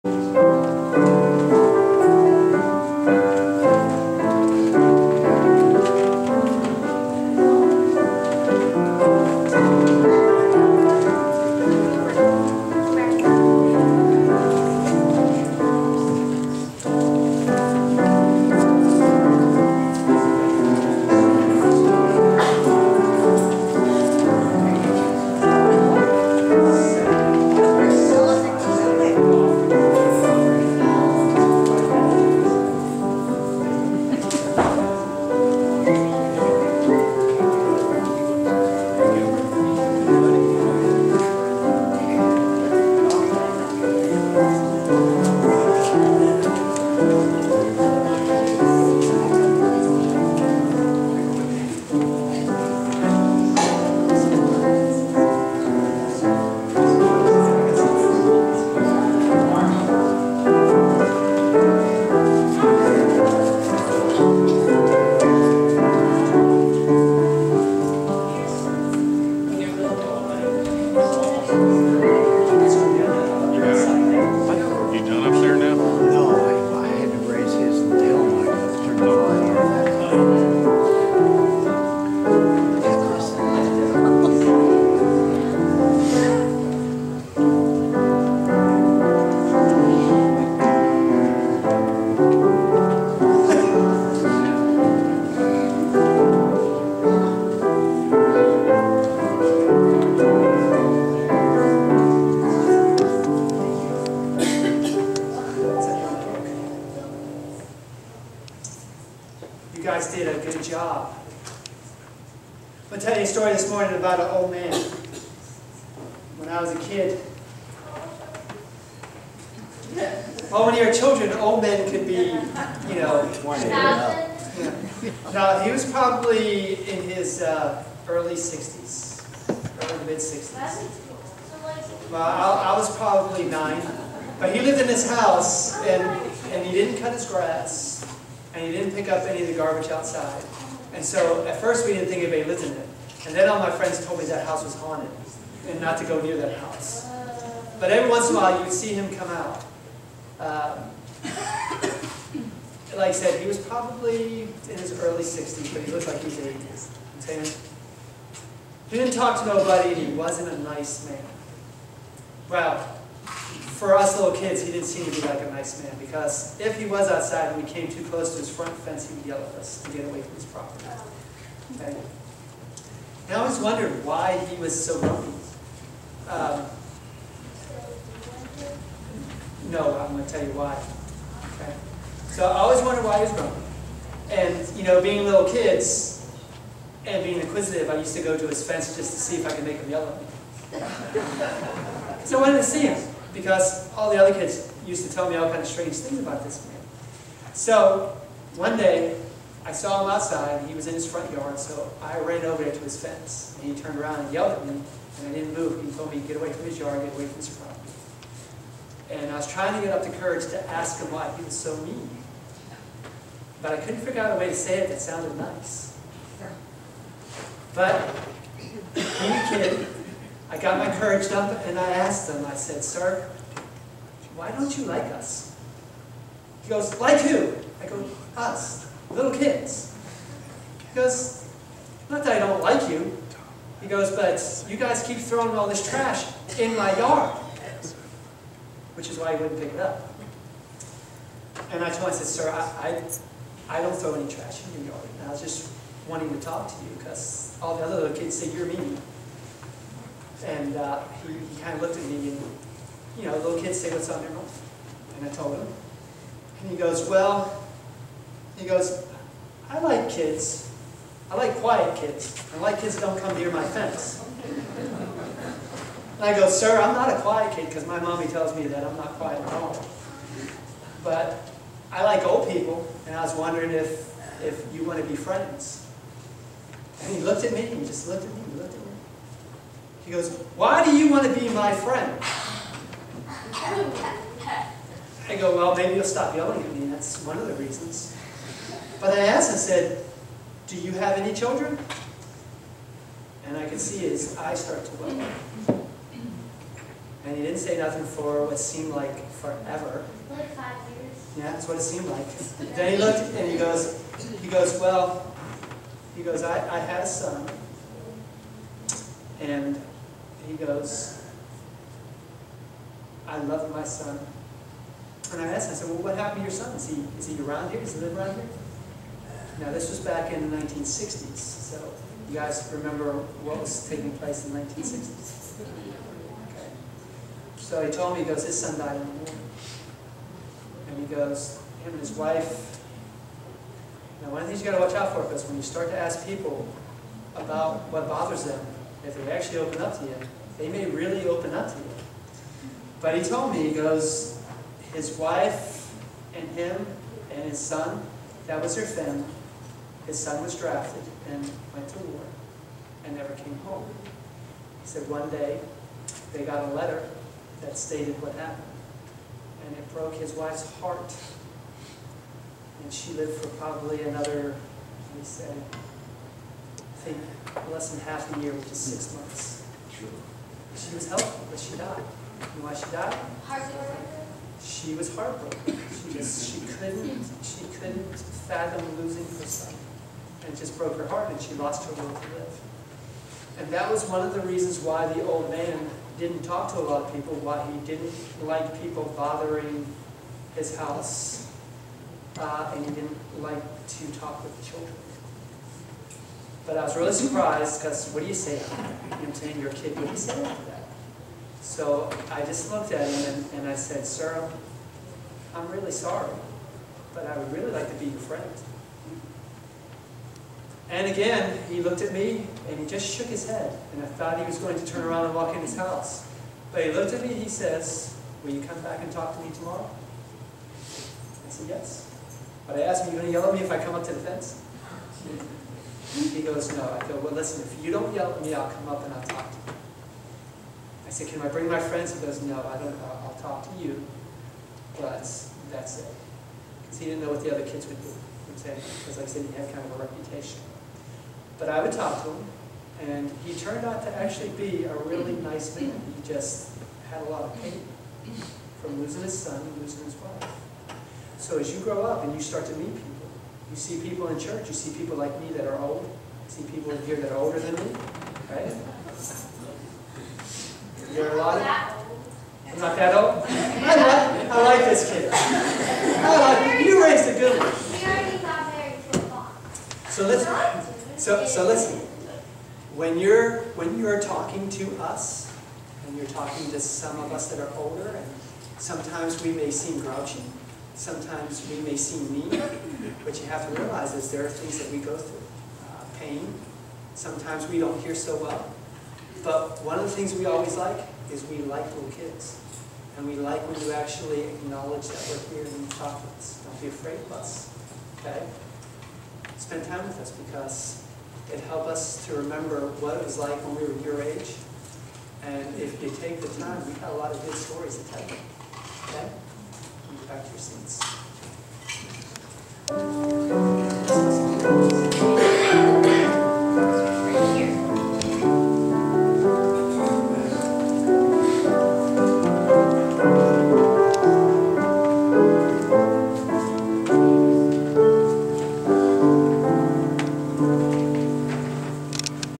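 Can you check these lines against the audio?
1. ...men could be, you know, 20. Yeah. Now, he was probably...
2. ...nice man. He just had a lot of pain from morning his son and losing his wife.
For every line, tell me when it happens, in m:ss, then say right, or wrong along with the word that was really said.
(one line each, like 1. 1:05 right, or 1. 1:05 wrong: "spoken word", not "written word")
1. 2:01 right
2. 7:25 wrong: "losing", not "morning".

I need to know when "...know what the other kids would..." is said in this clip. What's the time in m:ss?
7:17.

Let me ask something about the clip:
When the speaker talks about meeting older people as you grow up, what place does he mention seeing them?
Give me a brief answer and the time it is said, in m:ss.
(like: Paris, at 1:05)
Church, at 7:34.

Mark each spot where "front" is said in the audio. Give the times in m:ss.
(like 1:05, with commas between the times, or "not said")
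2:48, 3:21.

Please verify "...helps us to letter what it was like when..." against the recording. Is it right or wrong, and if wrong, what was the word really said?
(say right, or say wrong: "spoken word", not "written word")
wrong: "remember", not "letter".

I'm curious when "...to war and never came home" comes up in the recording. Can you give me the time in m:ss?
5:51.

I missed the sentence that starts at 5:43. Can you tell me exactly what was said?
But he told me, he goes, his wife and him and his son, that was their family.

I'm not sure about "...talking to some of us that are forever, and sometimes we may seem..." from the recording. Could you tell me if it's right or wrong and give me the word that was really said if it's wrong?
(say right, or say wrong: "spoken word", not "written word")
wrong: "older", not "forever".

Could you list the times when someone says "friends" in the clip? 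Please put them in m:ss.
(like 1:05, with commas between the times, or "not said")
2:23, 4:35, 4:41, 6:48, 7:11.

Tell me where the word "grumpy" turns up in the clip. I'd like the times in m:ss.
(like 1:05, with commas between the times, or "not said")
2:54, 3:03.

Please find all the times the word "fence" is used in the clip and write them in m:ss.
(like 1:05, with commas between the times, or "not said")
2:48, 3:08, 3:23, 4:23, 7:04.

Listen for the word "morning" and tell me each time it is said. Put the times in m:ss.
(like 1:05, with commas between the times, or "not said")
1:53, 5:29.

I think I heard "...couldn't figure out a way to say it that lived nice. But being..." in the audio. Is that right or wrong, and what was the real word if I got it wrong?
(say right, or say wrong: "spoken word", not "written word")
wrong: "sounded", not "lived".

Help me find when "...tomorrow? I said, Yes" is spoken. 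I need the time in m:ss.
6:59.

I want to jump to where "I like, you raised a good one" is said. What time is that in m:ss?
7:45.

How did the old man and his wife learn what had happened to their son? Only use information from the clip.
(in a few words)
A letter.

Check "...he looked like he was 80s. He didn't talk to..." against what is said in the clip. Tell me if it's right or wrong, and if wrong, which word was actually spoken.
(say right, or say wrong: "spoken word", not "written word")
right.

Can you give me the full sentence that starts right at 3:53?
He goes, But you guys keep throwing all this trash in my yard, which is why he wouldn't pick it up.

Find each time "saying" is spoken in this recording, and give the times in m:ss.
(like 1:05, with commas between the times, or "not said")
6:39.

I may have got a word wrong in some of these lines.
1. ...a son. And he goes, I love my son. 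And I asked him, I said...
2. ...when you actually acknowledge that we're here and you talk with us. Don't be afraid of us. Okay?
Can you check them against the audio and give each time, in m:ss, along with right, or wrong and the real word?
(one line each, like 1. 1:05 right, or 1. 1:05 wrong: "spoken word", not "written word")
1. 5:07 right
2. 8:13 right.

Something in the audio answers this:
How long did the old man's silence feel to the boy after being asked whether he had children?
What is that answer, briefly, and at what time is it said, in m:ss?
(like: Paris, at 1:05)
5 years, at 5:00.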